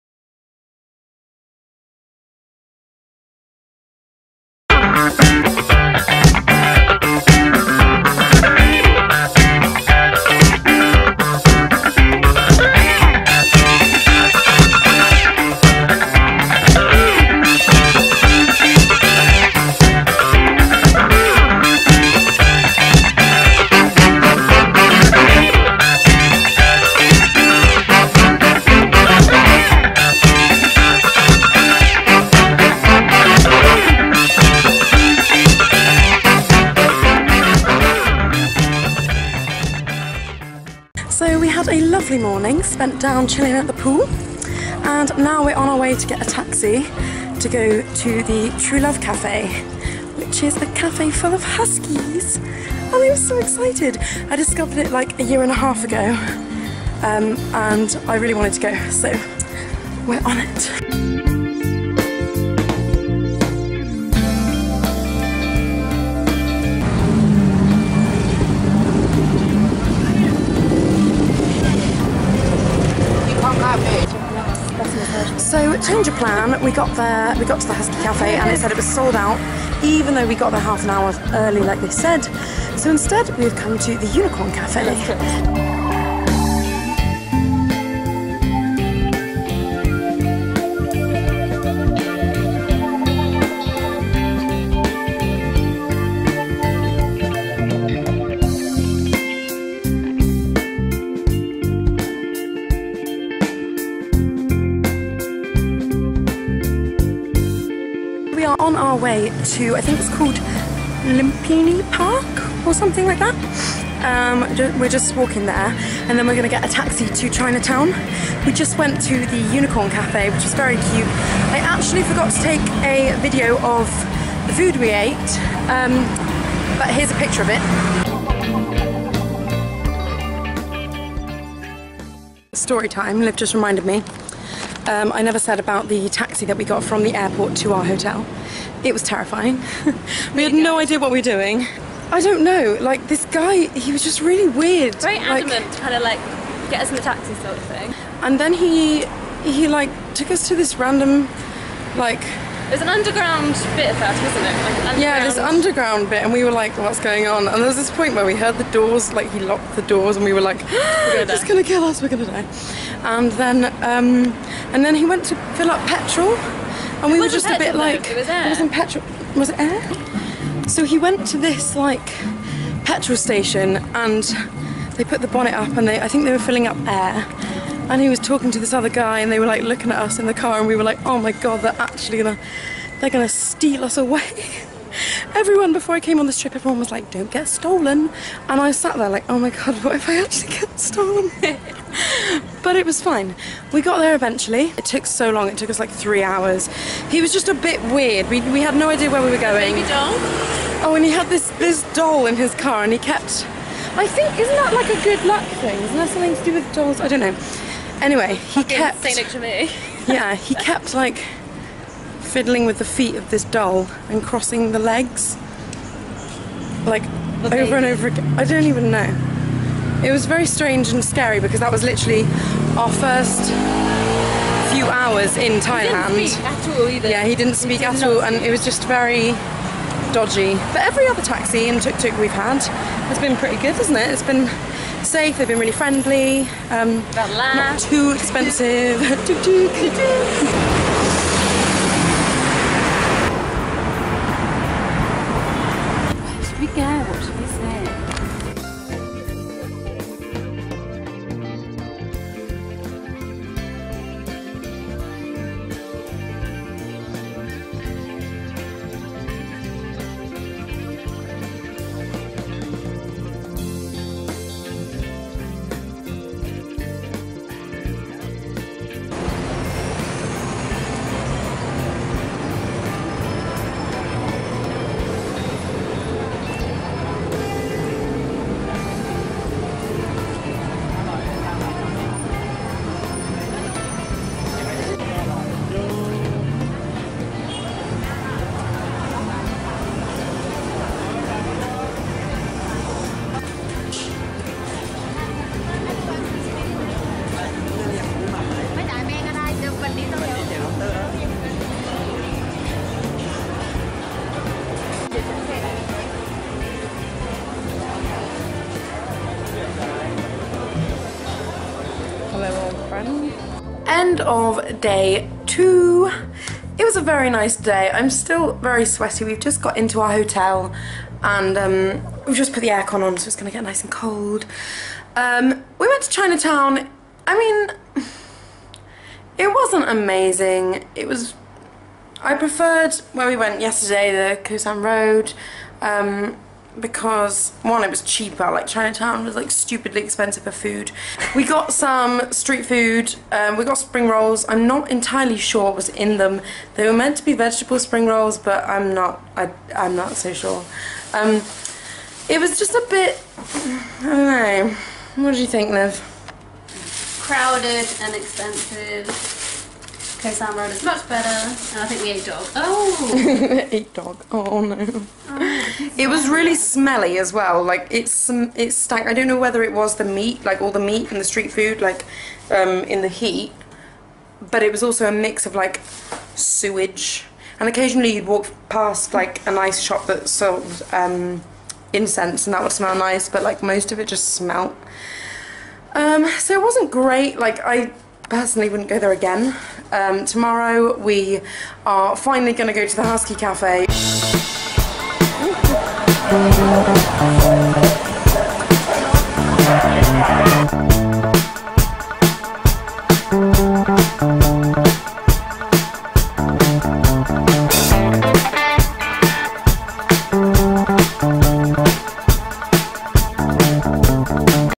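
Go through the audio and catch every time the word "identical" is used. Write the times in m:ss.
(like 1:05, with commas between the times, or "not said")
not said.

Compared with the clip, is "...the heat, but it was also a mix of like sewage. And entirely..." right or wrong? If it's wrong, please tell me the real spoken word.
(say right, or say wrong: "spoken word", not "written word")
wrong: "occasionally", not "entirely".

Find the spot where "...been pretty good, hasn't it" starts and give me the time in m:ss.
3:53.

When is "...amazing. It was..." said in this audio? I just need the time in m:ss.
5:29.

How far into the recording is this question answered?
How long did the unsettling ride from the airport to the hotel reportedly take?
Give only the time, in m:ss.
3:15.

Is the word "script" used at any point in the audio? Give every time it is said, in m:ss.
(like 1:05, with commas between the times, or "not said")
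not said.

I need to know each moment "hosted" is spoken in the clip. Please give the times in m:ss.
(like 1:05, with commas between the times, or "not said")
not said.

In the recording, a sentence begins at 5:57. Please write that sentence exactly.
crowded and expensive Khao San Road is much better, and I think we ate dog.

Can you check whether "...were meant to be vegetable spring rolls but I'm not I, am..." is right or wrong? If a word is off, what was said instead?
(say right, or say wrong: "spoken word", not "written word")
right.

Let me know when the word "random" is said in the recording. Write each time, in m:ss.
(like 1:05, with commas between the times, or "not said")
2:30.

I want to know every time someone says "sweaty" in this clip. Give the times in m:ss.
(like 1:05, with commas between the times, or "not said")
5:18.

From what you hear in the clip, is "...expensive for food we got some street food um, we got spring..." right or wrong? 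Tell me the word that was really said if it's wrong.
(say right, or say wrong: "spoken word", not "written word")
right.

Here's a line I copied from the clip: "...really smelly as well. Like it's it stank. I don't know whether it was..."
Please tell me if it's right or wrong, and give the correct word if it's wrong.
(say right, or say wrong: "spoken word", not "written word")
right.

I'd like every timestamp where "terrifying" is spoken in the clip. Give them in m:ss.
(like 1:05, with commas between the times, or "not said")
2:19.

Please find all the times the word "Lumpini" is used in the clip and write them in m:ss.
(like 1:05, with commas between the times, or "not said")
1:51.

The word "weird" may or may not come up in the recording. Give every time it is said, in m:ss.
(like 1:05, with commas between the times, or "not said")
2:24, 3:17.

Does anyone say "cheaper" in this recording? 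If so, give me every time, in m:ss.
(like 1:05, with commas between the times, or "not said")
5:38.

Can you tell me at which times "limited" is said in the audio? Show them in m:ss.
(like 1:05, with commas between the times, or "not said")
not said.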